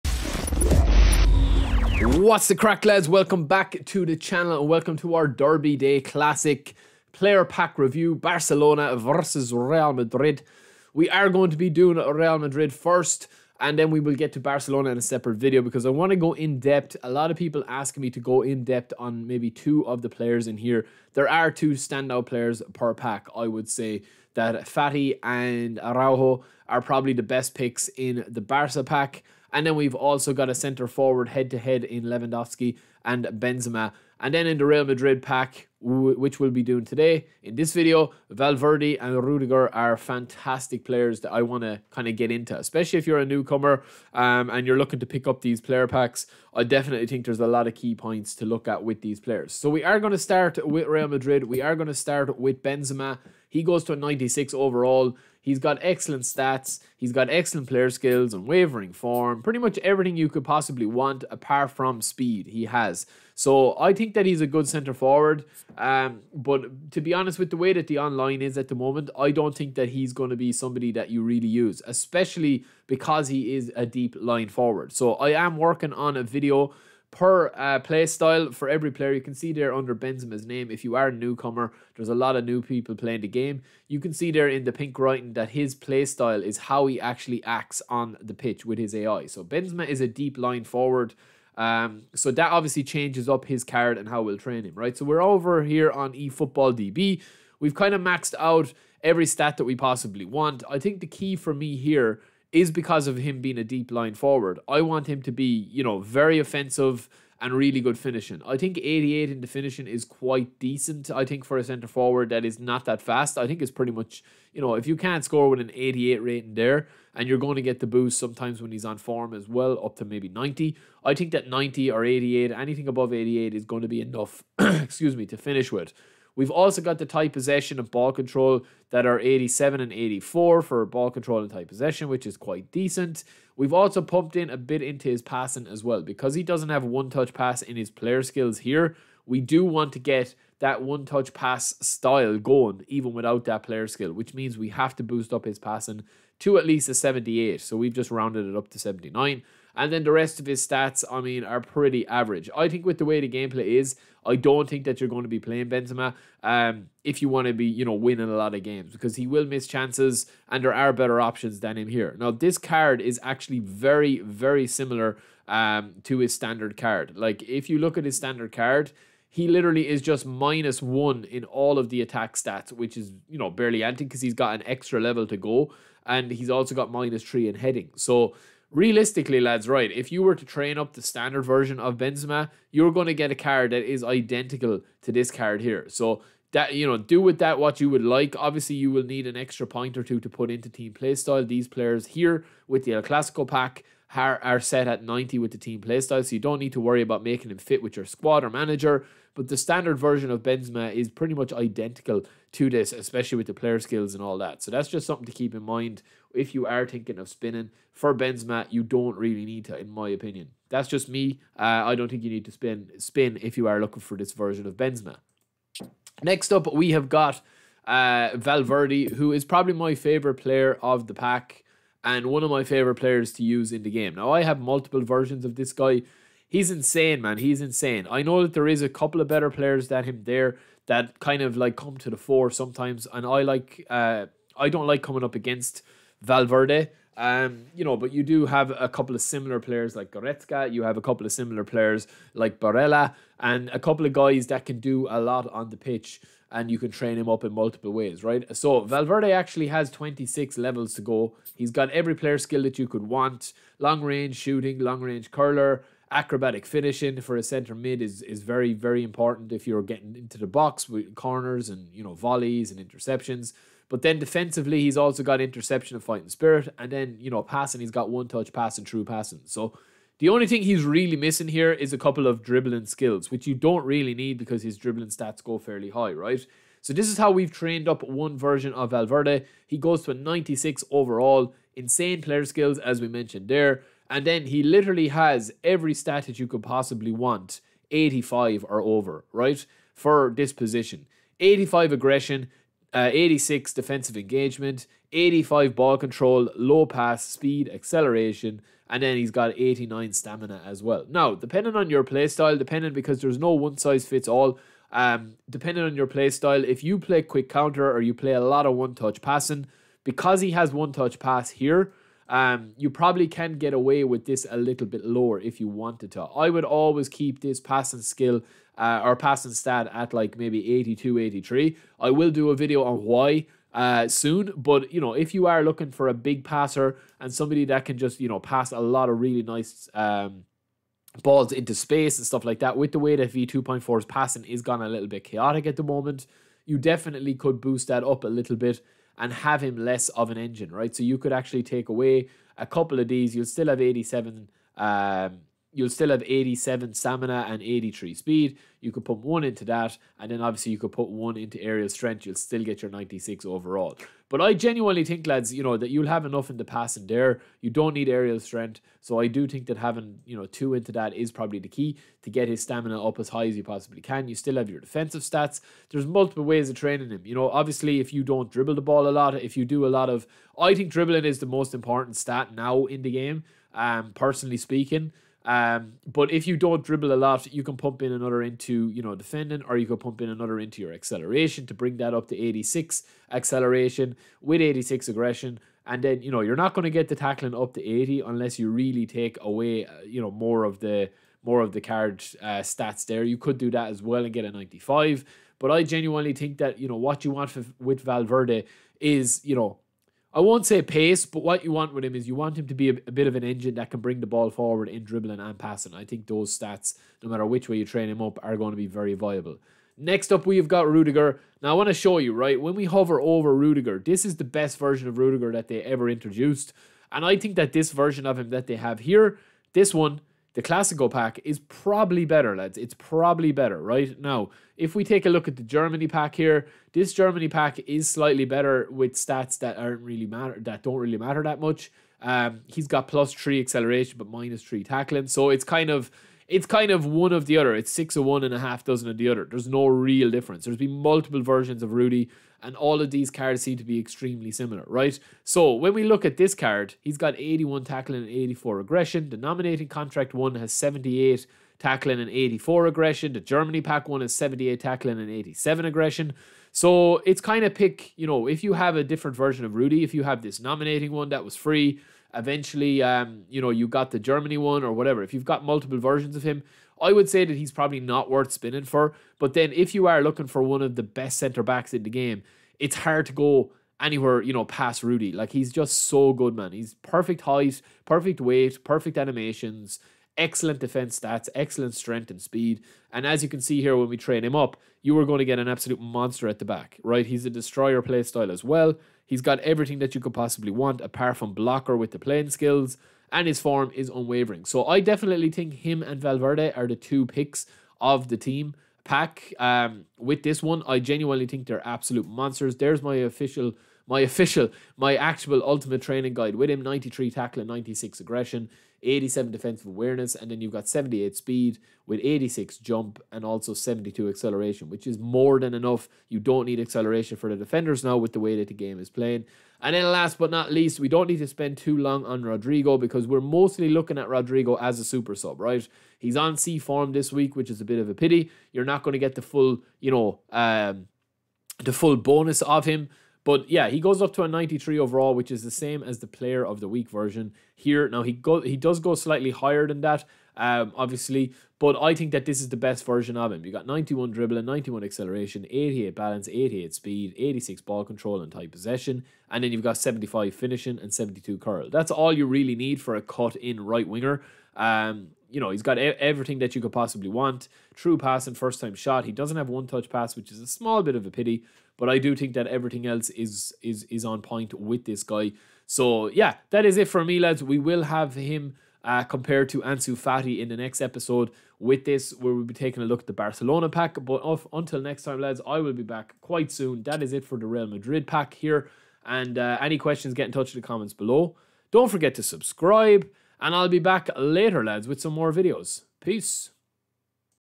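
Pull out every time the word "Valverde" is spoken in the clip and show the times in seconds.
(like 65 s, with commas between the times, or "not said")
38 s, 218 s, 236 s, 248 s, 278 s, 398 s, 496 s.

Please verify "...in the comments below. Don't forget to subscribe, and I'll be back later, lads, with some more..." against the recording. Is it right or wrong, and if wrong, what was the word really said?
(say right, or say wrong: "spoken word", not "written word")
right.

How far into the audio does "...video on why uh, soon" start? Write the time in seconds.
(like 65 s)
322 s.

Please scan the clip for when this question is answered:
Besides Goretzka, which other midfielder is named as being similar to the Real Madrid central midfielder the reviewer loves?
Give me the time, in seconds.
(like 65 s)
242 s.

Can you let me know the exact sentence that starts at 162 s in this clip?
Now, this card is actually very, very similar um, to his standard card.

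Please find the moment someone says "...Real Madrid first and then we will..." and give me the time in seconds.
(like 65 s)
11 s.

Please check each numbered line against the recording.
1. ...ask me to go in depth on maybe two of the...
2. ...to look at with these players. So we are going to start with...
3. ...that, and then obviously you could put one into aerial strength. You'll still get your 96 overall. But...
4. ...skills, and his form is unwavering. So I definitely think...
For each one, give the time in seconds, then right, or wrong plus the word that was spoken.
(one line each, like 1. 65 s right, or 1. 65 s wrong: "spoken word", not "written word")
1. 17 s right
2. 48 s right
3. 349 s right
4. 492 s right.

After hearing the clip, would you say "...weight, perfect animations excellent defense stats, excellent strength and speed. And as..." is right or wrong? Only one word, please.
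right.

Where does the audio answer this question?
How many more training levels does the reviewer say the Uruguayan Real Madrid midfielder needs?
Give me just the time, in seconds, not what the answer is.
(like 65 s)
249 s.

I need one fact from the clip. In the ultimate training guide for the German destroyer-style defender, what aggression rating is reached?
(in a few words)
96.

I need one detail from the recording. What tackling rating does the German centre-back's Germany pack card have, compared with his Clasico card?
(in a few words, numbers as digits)
78.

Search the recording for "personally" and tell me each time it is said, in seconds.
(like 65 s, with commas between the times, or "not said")
374 s.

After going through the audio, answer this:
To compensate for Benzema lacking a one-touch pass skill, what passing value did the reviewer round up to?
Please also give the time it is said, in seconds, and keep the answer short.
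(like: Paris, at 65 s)
79, at 148 s.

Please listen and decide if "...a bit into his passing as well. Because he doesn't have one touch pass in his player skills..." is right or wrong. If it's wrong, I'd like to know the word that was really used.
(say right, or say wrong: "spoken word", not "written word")
right.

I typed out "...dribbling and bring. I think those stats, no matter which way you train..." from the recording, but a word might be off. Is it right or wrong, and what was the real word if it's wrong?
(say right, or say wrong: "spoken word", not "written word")
wrong: "passing", not "bring".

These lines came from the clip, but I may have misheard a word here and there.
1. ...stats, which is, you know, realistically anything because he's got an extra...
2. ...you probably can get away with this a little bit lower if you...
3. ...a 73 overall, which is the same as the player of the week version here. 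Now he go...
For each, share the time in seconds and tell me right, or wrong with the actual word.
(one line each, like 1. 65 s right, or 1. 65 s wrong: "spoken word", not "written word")
1. 172 s wrong: "barely", not "realistically"
2. 312 s right
3. 534 s wrong: "93", not "73".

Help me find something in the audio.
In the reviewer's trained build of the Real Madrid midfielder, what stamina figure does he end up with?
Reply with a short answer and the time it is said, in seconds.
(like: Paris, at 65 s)
89, at 299 s.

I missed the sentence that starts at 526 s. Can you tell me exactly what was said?
He's on C form this week, which is a bit of a pity.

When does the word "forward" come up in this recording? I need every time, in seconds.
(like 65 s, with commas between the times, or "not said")
30 s, 64 s, 74 s, 90 s, 104 s, 111 s, 404 s.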